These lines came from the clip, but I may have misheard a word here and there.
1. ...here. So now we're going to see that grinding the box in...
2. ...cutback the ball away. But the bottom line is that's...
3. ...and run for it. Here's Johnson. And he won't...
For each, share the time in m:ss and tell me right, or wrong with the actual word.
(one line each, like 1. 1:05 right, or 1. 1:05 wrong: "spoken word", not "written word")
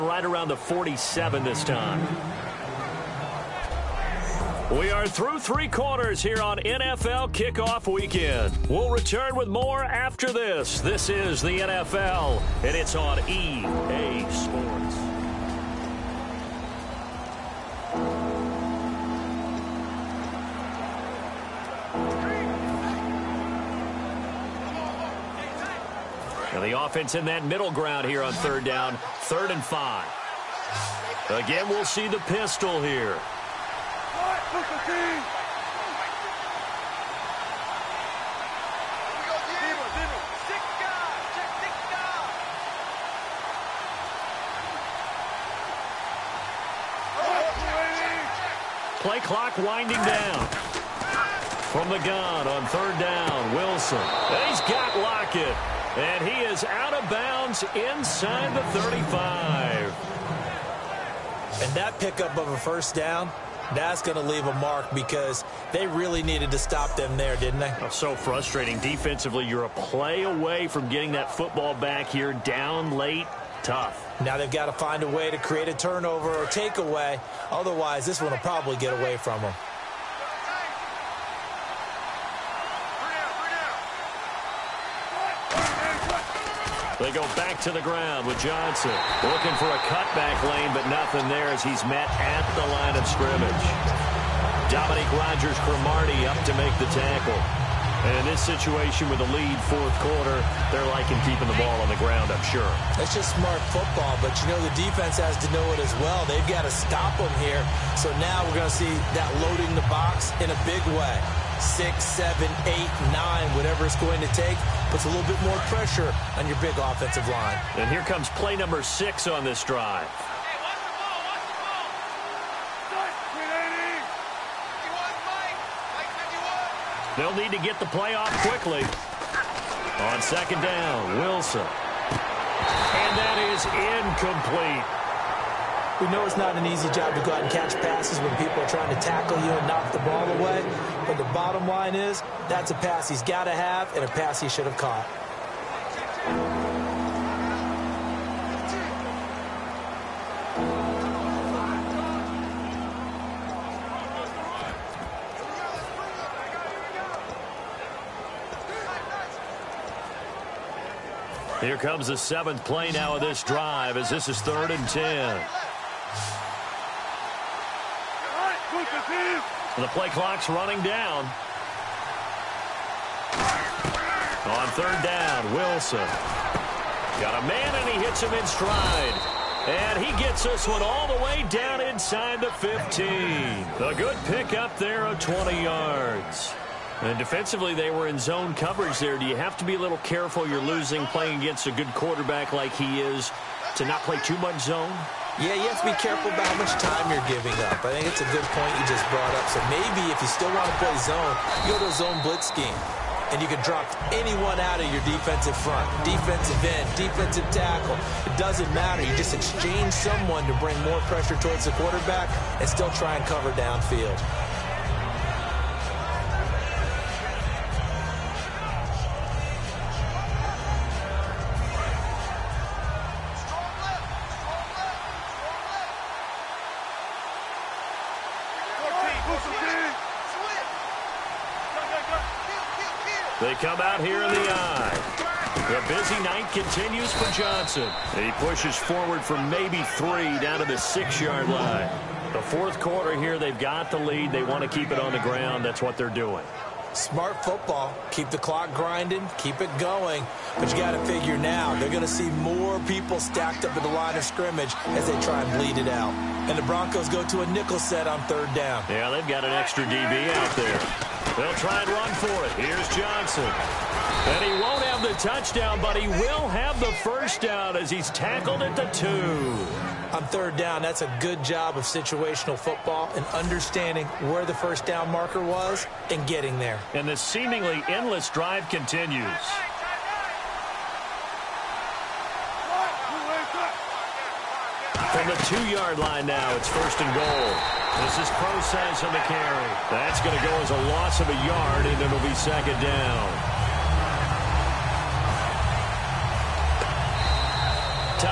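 1. 1:47 wrong: "loading", not "grinding"
2. 2:19 wrong: "knock", not "cutback"
3. 4:21 right.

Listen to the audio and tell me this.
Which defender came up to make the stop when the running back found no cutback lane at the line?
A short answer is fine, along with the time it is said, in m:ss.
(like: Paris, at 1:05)
Dominique Rodgers-Cromartie, at 1:34.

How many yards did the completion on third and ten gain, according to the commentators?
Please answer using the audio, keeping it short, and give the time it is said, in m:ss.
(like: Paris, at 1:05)
20, at 3:05.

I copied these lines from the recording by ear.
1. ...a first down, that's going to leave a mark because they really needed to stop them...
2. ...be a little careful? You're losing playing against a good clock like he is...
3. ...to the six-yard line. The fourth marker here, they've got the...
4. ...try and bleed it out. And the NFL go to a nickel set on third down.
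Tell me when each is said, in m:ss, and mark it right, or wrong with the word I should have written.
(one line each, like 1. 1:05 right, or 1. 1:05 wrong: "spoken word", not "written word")
1. 1:02 right
2. 3:09 wrong: "quarterback", not "clock"
3. 4:00 wrong: "quarter", not "marker"
4. 4:15 wrong: "Broncos", not "NFL".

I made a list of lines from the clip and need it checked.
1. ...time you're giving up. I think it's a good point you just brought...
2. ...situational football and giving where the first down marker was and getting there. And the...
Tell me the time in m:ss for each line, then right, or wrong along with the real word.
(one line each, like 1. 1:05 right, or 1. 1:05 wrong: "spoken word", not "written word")
1. 3:16 right
2. 4:31 wrong: "understanding", not "giving".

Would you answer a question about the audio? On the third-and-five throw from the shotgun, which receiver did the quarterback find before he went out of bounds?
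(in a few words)
Lockett.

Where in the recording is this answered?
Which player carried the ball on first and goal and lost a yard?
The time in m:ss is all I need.
4:48.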